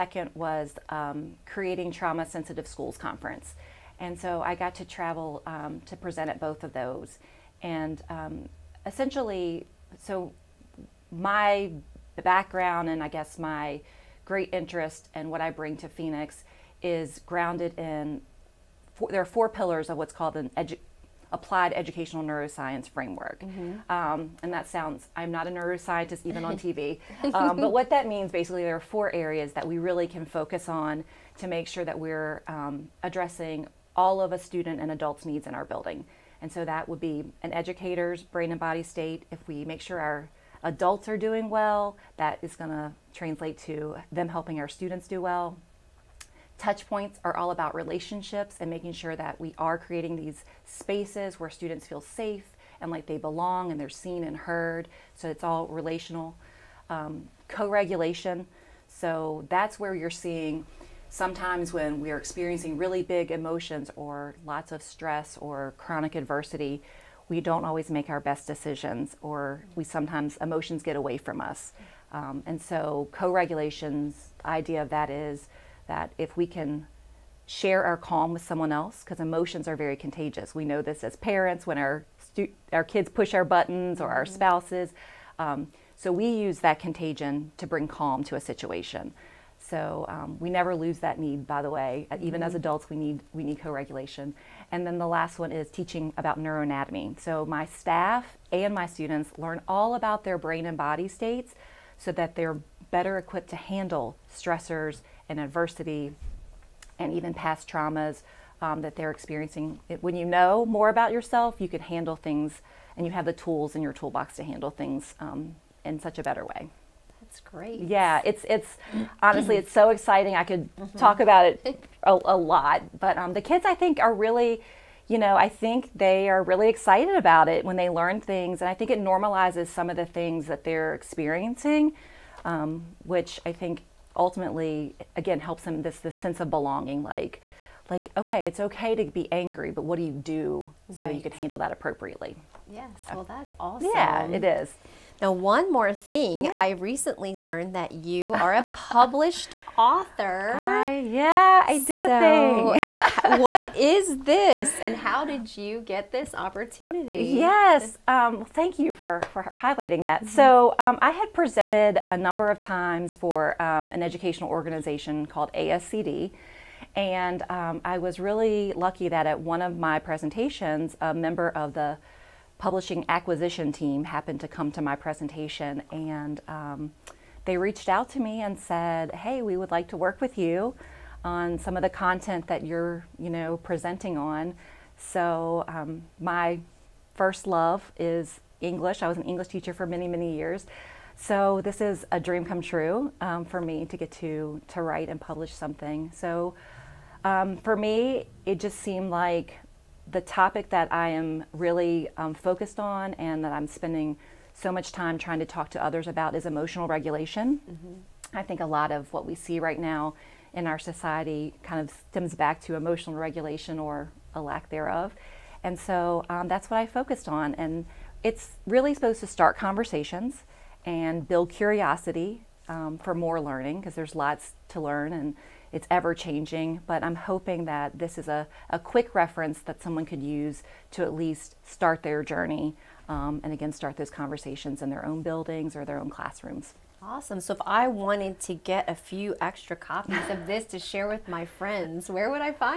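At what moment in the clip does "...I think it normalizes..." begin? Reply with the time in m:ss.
2:08.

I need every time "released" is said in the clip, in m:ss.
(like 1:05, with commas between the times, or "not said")
not said.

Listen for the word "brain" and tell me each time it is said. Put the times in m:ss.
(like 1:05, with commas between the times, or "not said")
0:38, 1:40.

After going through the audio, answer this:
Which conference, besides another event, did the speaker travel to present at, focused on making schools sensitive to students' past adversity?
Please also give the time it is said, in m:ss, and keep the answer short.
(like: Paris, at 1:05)
Creating Trauma Sensitive Schools Conference, at 0:01.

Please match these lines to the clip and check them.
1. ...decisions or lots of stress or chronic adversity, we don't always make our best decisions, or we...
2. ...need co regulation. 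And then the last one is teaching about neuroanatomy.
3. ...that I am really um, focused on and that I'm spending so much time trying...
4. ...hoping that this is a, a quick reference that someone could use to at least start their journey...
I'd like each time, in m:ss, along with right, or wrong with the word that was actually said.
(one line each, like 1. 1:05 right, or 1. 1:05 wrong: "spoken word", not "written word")
1. 1:03 wrong: "emotions", not "decisions"
2. 1:33 right
3. 3:20 right
4. 3:47 right.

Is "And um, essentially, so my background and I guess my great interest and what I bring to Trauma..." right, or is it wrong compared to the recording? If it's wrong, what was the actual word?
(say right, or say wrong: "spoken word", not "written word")
wrong: "Phoenix", not "Trauma".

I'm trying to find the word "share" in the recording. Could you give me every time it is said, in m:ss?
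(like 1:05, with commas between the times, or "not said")
1:17, 4:00.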